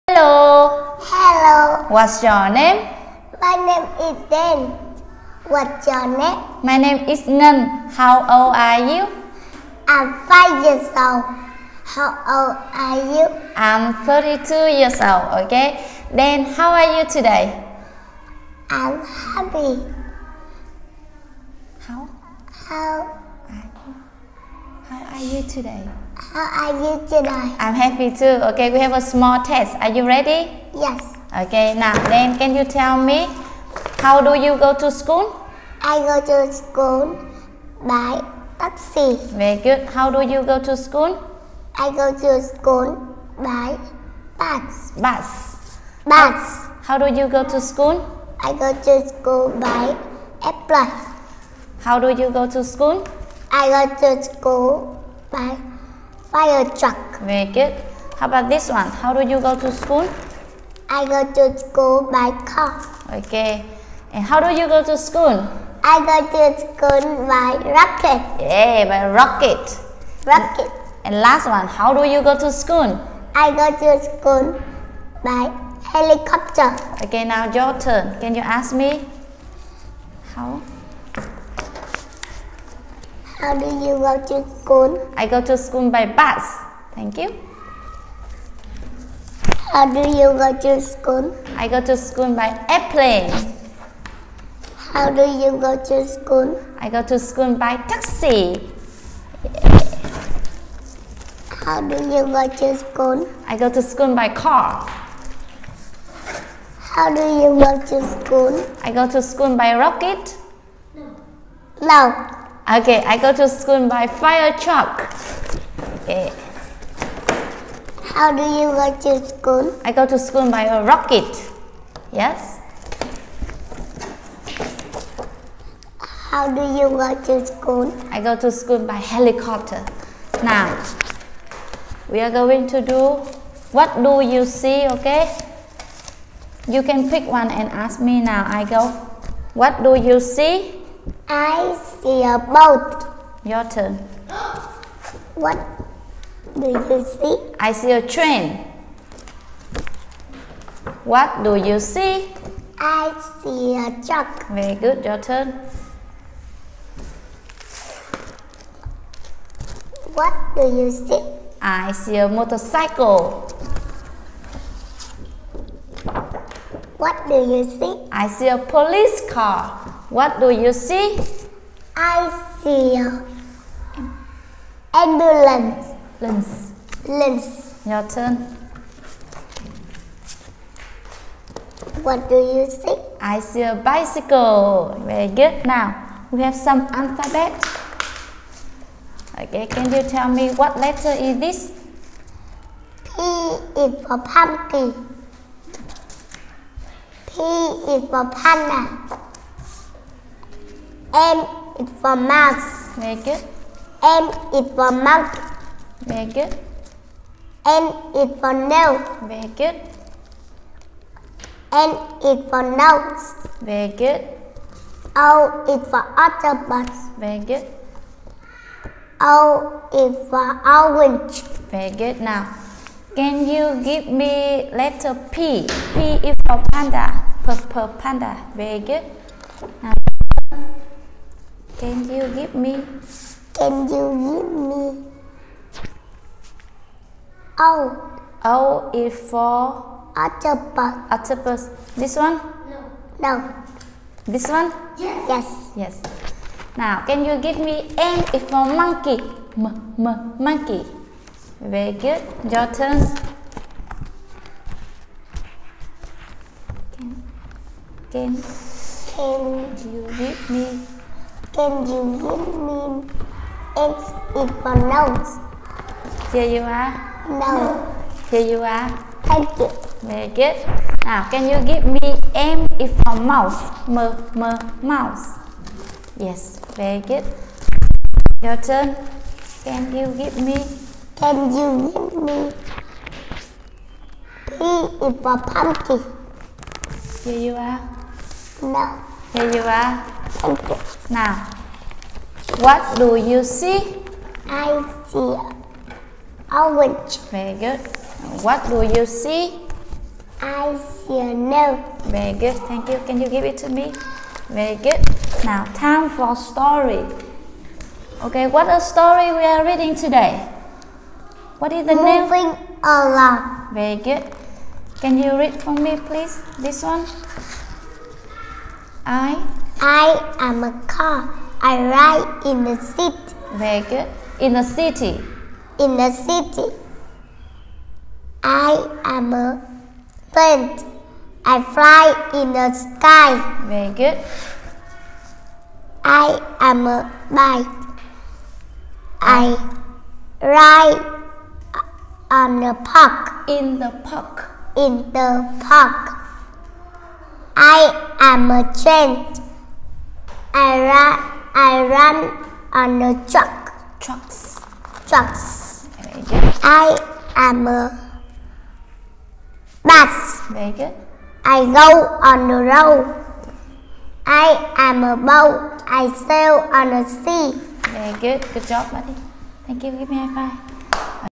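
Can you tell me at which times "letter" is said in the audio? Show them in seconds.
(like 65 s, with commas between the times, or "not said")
190 s, 224 s.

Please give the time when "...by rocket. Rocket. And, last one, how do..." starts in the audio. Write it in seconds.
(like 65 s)
68 s.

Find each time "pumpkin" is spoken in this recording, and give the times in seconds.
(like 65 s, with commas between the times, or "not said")
194 s, 285 s.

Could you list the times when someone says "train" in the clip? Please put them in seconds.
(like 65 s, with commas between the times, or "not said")
148 s, 348 s.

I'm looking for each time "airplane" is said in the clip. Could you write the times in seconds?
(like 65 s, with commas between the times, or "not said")
50 s, 92 s.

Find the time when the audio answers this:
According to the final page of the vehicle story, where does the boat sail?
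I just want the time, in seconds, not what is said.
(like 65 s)
367 s.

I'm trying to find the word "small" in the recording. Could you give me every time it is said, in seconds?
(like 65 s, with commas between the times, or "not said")
29 s.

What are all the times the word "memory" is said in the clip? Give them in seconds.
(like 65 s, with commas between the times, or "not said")
not said.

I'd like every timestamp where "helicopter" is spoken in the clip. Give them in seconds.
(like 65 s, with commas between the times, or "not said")
75 s, 129 s.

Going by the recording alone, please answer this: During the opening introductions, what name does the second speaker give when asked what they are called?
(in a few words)
Nan.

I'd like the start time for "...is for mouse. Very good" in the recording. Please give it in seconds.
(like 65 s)
201 s.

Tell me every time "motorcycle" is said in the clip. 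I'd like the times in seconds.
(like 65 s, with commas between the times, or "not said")
162 s.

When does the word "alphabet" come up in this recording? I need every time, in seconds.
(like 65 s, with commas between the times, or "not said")
186 s.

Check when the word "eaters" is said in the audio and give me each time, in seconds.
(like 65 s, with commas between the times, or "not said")
not said.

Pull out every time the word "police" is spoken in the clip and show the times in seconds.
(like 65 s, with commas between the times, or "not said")
168 s.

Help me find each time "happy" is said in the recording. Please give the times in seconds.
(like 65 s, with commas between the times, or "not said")
19 s, 27 s.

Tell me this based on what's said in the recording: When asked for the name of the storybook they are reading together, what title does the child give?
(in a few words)
Moving Along.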